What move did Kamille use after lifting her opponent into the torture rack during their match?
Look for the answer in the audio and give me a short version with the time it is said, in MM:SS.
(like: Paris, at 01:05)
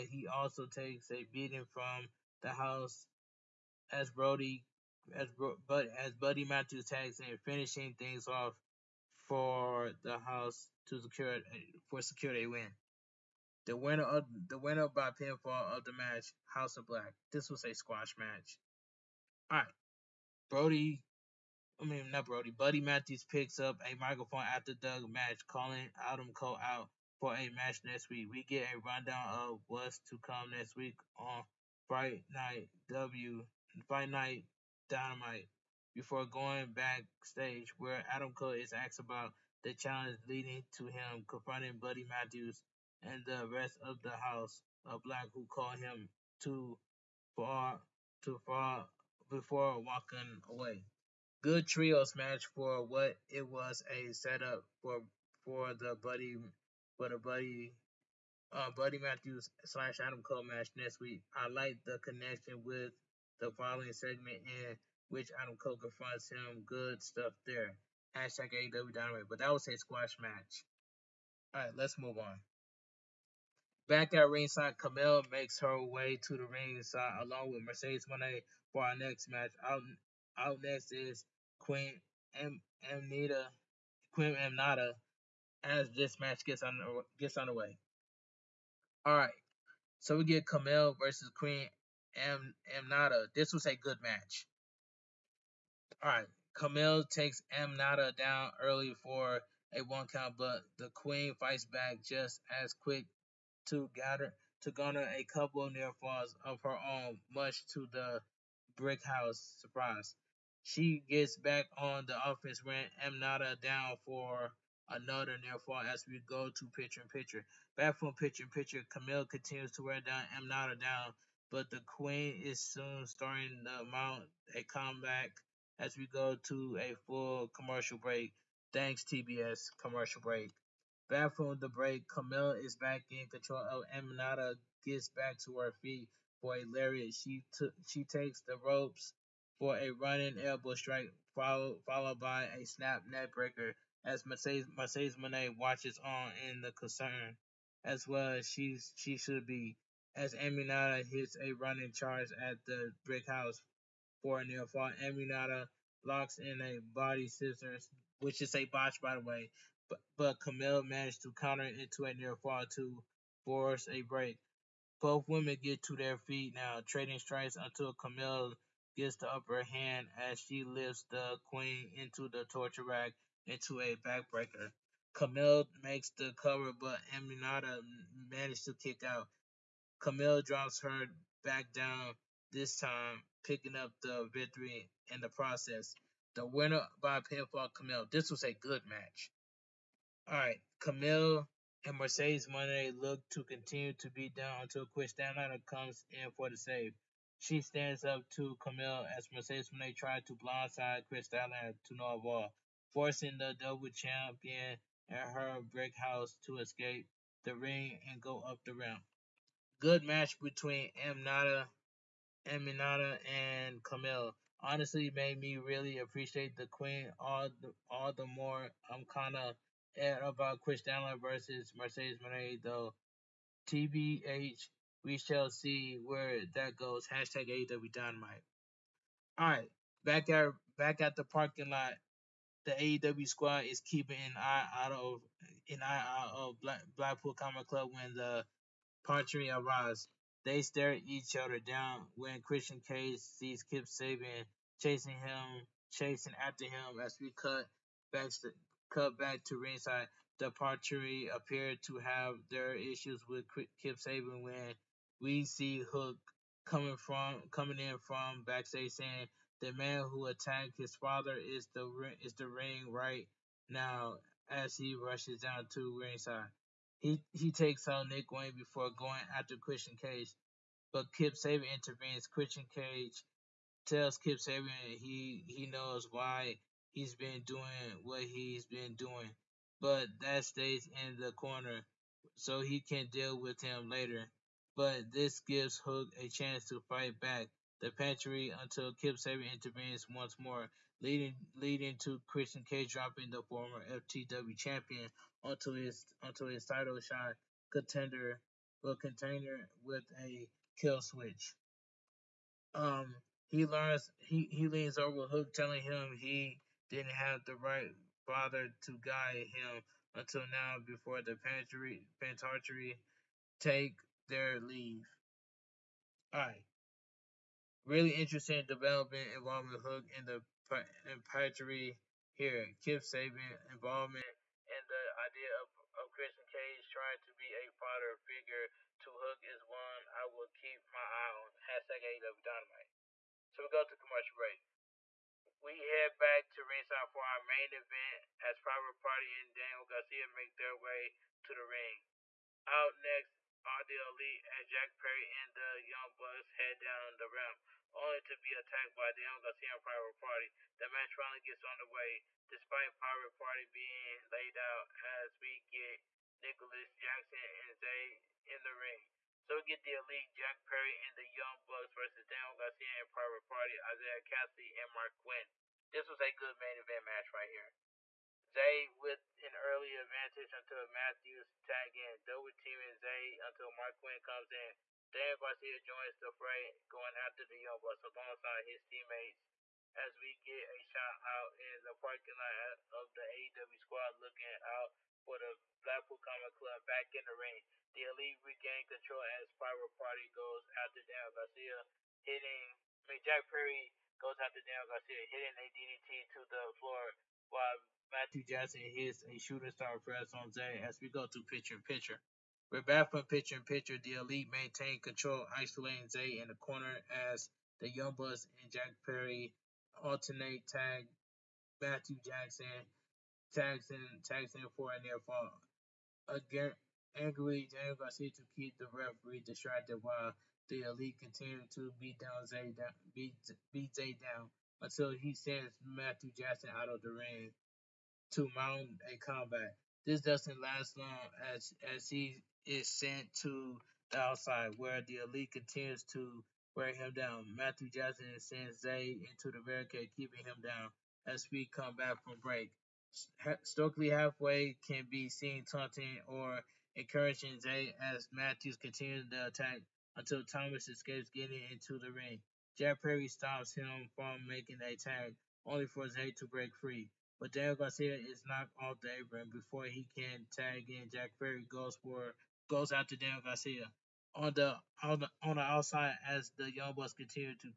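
Backbreaker, at 02:53.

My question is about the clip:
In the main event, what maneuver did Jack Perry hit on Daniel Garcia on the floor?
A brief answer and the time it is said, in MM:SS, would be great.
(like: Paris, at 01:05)
DDT, at 06:35.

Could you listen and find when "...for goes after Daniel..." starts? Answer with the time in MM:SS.
07:42.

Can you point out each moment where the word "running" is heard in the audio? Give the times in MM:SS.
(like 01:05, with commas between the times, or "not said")
02:19, 02:31.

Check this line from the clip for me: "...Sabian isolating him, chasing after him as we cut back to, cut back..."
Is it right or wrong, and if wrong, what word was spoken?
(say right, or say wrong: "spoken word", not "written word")
wrong: "chasing", not "isolating".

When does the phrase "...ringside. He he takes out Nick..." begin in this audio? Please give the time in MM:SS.
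04:25.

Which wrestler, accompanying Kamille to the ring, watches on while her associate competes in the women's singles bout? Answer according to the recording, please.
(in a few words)
Mercedes Moné.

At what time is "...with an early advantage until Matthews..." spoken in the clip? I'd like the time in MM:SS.
06:08.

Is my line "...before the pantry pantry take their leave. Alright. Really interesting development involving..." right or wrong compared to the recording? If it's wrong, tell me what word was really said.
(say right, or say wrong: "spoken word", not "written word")
right.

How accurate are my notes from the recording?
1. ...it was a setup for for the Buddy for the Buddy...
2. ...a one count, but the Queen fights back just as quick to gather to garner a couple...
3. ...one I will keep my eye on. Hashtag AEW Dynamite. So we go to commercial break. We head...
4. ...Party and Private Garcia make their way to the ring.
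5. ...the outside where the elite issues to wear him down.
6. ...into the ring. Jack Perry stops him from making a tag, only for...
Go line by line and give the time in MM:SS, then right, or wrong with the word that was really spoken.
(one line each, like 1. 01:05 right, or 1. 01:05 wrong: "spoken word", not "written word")
1. 00:53 right
2. 01:39 right
3. 05:29 right
4. 05:39 wrong: "Daniel", not "Private"
5. 07:14 wrong: "continues", not "issues"
6. 07:31 right.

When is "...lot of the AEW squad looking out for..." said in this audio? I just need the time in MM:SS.
06:22.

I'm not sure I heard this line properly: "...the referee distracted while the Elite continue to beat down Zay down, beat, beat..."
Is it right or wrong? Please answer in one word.
right.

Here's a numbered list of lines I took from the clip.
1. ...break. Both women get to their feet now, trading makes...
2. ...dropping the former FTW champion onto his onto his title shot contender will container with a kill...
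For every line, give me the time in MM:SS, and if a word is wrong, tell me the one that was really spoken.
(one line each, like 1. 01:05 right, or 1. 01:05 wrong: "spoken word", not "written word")
1. 02:44 wrong: "strikes", not "makes"
2. 04:52 right.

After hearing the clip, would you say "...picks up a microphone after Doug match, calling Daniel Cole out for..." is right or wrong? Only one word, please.
wrong.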